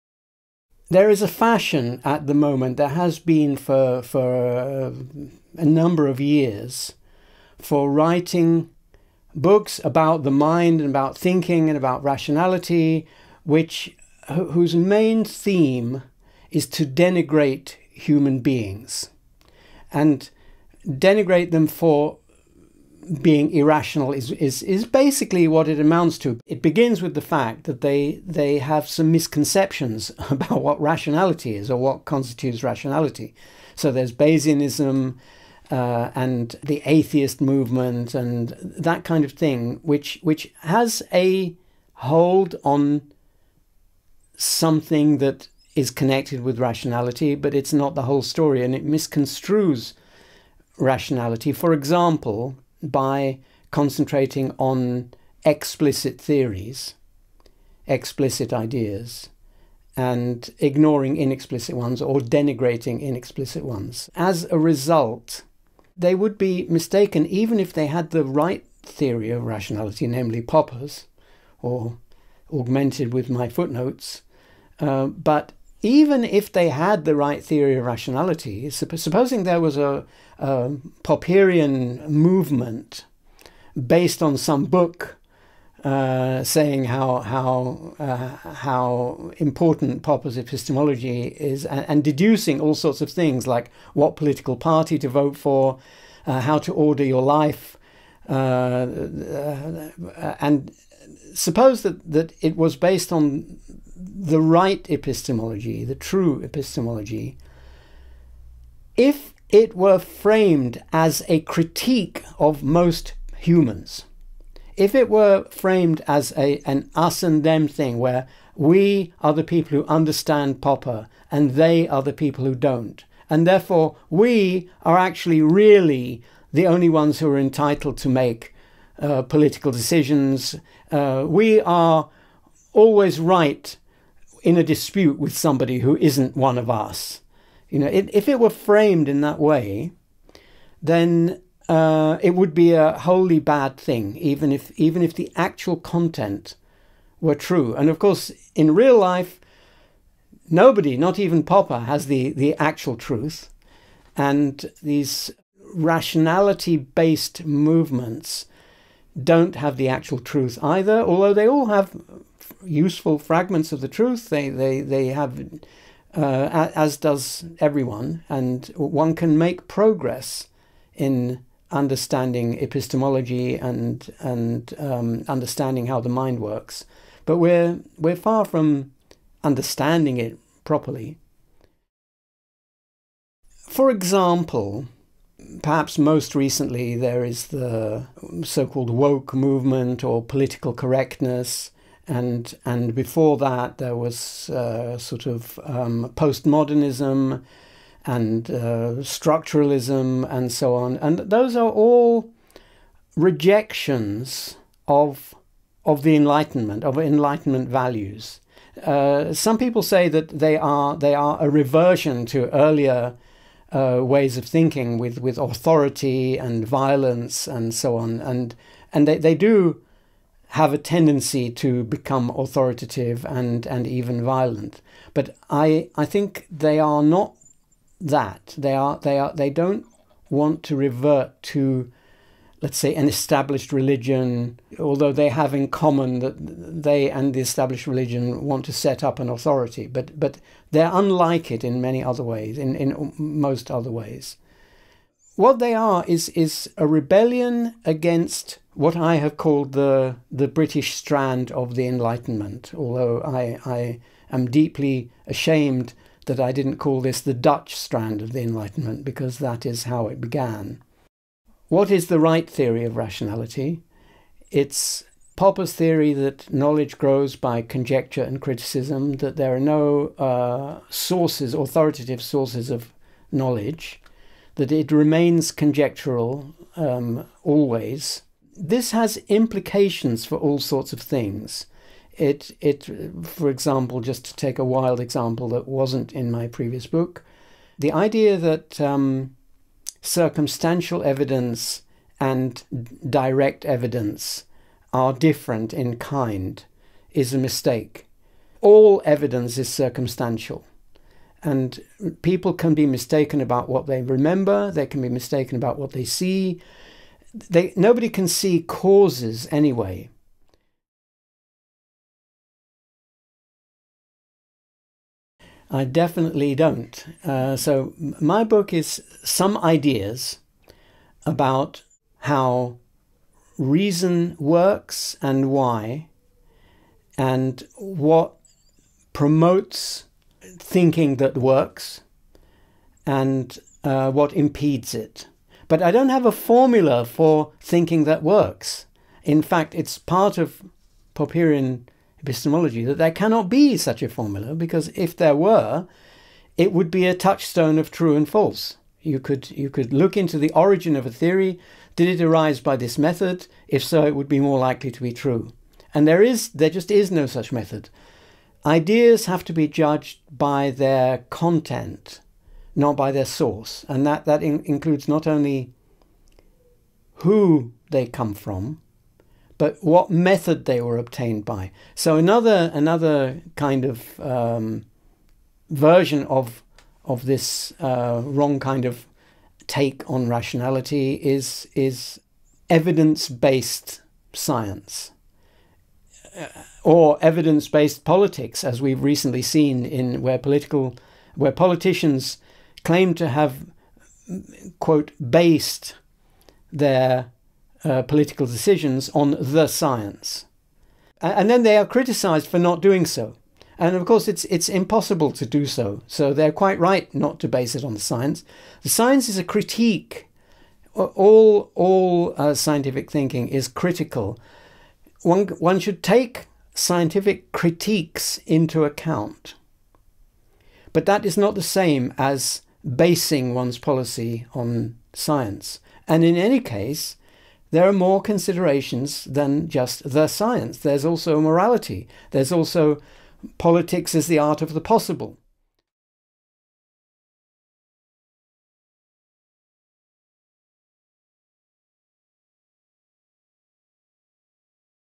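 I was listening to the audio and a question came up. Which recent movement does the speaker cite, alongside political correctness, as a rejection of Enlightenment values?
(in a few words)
woke movement.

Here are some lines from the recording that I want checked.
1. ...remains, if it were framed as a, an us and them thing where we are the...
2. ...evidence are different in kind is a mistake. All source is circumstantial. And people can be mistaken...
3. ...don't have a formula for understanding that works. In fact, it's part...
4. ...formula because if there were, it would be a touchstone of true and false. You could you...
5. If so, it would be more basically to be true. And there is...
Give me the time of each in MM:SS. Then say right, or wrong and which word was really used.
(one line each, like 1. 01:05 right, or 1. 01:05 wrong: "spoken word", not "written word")
1. 01:53 wrong: "humans", not "remains"
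2. 04:53 wrong: "evidence", not "source"
3. 05:35 wrong: "thinking", not "understanding"
4. 05:44 right
5. 05:53 wrong: "likely", not "basically".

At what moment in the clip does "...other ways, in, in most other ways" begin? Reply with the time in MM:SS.
04:02.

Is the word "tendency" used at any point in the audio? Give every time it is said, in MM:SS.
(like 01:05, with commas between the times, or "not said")
03:40.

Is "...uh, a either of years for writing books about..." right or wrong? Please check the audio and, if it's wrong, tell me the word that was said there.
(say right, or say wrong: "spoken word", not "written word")
wrong: "number", not "either".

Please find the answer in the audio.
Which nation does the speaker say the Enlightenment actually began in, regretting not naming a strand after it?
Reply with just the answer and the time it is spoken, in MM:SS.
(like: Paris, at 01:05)
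Dutch, at 04:17.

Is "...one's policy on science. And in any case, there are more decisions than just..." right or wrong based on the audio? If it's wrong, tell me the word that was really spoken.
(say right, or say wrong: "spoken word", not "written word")
wrong: "considerations", not "decisions".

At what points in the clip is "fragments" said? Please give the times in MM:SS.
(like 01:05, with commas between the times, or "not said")
02:43.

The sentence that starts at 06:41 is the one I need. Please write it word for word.
And then they are criticized for not doing so.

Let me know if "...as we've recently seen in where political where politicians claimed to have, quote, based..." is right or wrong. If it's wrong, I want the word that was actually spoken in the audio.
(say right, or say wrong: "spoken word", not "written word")
right.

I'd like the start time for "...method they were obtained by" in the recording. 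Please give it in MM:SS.
06:10.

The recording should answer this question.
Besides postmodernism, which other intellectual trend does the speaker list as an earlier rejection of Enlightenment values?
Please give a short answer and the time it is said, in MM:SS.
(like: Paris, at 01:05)
structuralism, at 03:19.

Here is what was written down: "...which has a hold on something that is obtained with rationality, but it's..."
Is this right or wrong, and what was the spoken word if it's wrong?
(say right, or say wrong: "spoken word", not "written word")
wrong: "connected", not "obtained".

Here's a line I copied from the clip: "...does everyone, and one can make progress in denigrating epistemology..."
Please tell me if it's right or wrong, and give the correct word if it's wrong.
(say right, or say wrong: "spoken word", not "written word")
wrong: "understanding", not "denigrating".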